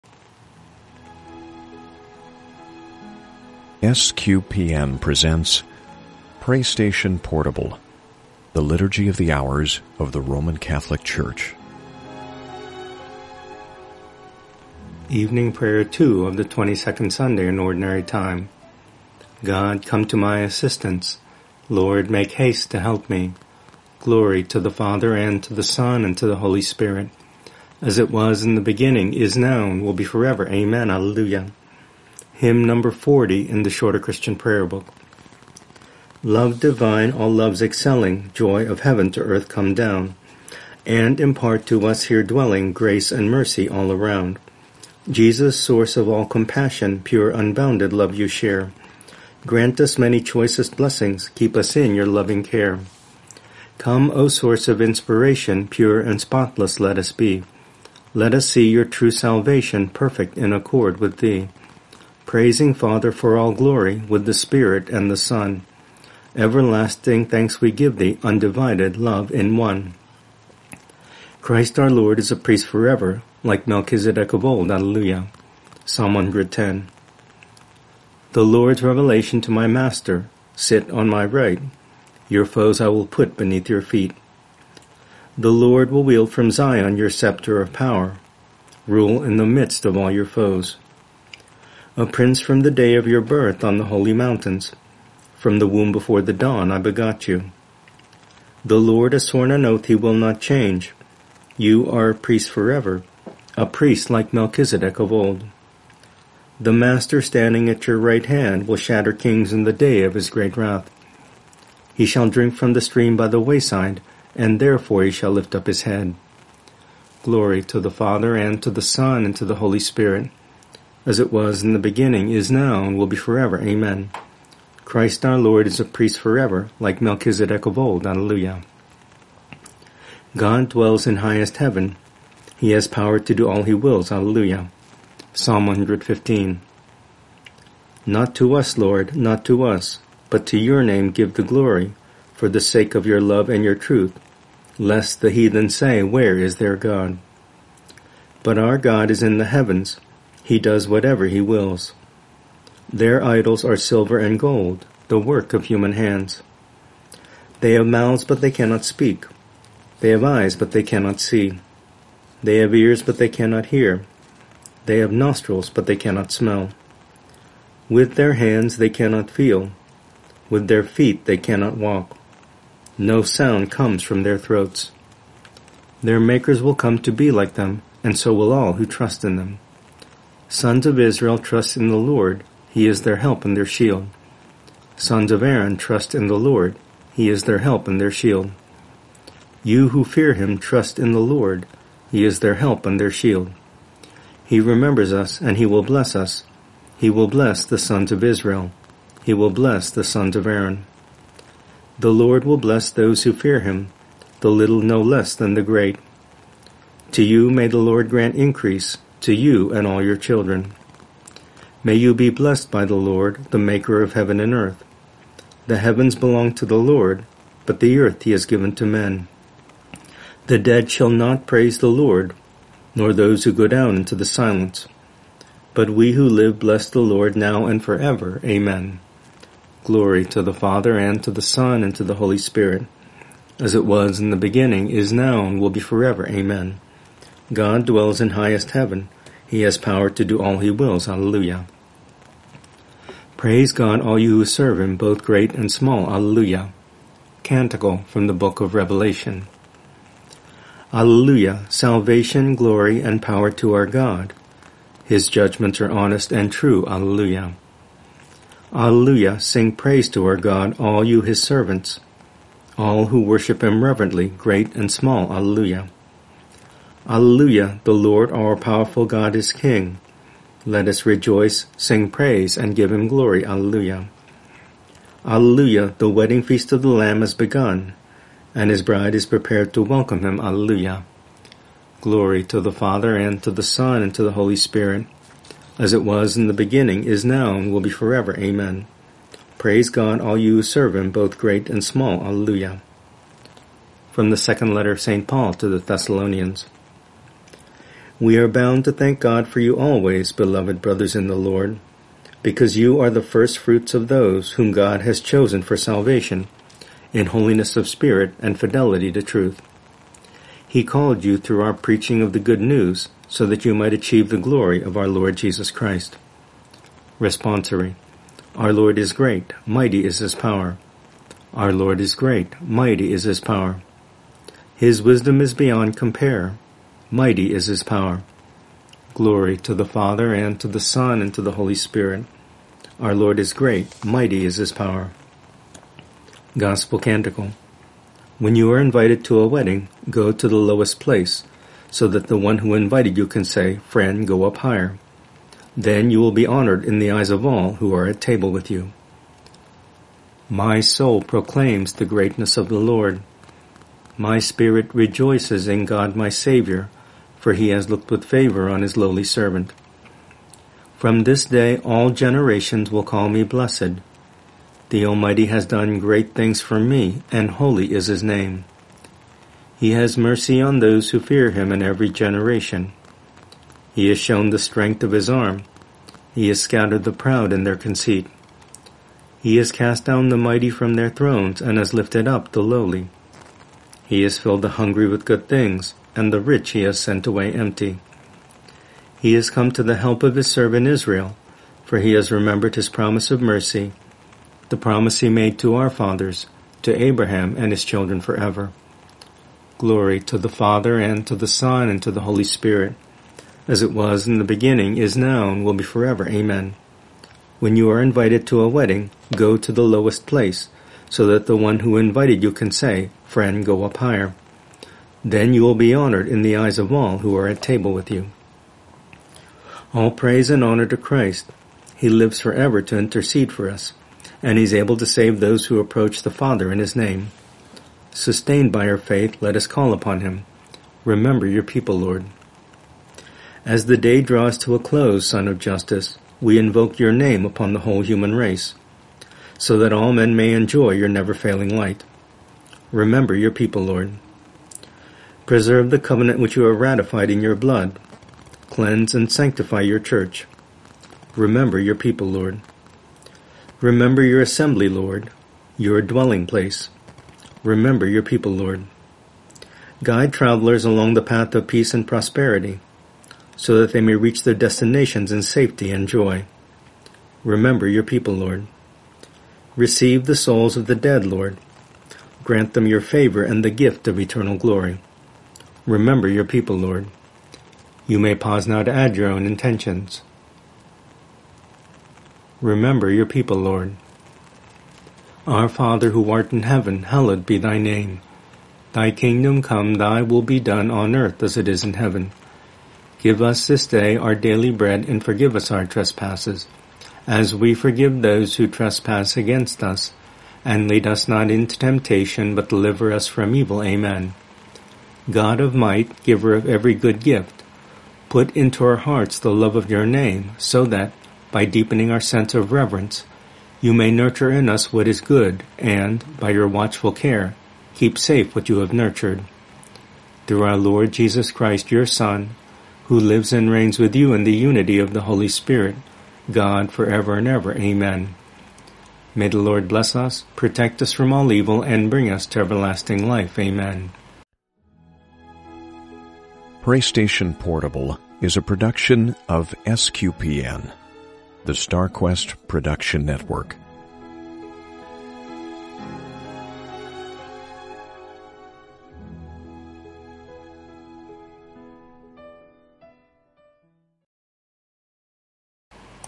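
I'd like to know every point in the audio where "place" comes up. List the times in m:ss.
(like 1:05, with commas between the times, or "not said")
5:41, 6:50, 7:36.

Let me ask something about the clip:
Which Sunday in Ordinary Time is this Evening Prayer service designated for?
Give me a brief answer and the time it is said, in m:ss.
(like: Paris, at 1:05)
22nd, at 0:16.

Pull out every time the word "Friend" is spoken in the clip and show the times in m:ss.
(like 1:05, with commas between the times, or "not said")
5:43, 6:53.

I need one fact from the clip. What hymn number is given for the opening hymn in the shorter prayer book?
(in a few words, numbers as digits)
40.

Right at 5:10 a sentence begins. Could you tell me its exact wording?
He called you through our preaching of the good news, so that you might achieve the glory of our Lord Jesus Christ.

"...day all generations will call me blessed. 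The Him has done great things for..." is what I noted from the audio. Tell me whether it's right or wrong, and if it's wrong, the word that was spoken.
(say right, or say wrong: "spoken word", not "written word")
wrong: "Almighty", not "Him".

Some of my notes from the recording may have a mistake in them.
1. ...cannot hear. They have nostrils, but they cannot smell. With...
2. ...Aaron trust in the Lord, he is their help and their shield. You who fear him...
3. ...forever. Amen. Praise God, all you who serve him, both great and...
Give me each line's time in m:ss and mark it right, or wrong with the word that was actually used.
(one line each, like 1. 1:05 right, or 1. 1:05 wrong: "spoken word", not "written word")
1. 2:43 right
2. 3:05 right
3. 4:47 right.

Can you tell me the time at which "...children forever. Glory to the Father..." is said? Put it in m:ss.
6:37.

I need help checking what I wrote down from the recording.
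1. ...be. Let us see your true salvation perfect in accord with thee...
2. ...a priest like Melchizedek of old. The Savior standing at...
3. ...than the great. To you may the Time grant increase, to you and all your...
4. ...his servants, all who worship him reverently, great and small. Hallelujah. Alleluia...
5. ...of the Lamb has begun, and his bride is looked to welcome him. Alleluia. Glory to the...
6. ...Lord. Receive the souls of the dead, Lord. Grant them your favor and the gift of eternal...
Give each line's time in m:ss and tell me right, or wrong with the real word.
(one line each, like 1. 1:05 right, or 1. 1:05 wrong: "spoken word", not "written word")
1. 0:57 right
2. 1:43 wrong: "Master", not "Savior"
3. 3:25 wrong: "Lord", not "Time"
4. 4:21 right
5. 4:36 wrong: "prepared", not "looked"
6. 7:48 right.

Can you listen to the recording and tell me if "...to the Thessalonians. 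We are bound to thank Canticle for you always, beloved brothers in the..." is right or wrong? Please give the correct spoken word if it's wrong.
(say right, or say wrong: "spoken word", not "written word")
wrong: "God", not "Canticle".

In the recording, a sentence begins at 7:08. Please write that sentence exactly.
Sustained by our faith, let us call upon Him.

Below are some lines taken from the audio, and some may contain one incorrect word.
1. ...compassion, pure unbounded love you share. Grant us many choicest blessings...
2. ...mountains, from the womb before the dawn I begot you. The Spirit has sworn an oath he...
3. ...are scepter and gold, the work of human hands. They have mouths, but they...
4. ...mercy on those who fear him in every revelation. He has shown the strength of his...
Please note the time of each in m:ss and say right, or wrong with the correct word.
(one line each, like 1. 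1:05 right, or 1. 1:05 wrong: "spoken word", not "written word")
1. 0:46 right
2. 1:34 wrong: "Lord", not "Spirit"
3. 2:33 wrong: "silver", not "scepter"
4. 6:10 wrong: "generation", not "revelation".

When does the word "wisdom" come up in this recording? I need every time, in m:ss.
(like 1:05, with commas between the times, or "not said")
5:25.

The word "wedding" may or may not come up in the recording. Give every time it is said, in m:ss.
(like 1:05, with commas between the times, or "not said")
4:36, 5:39, 6:48.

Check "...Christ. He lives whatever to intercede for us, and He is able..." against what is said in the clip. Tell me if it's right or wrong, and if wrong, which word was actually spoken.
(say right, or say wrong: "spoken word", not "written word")
wrong: "forever", not "whatever".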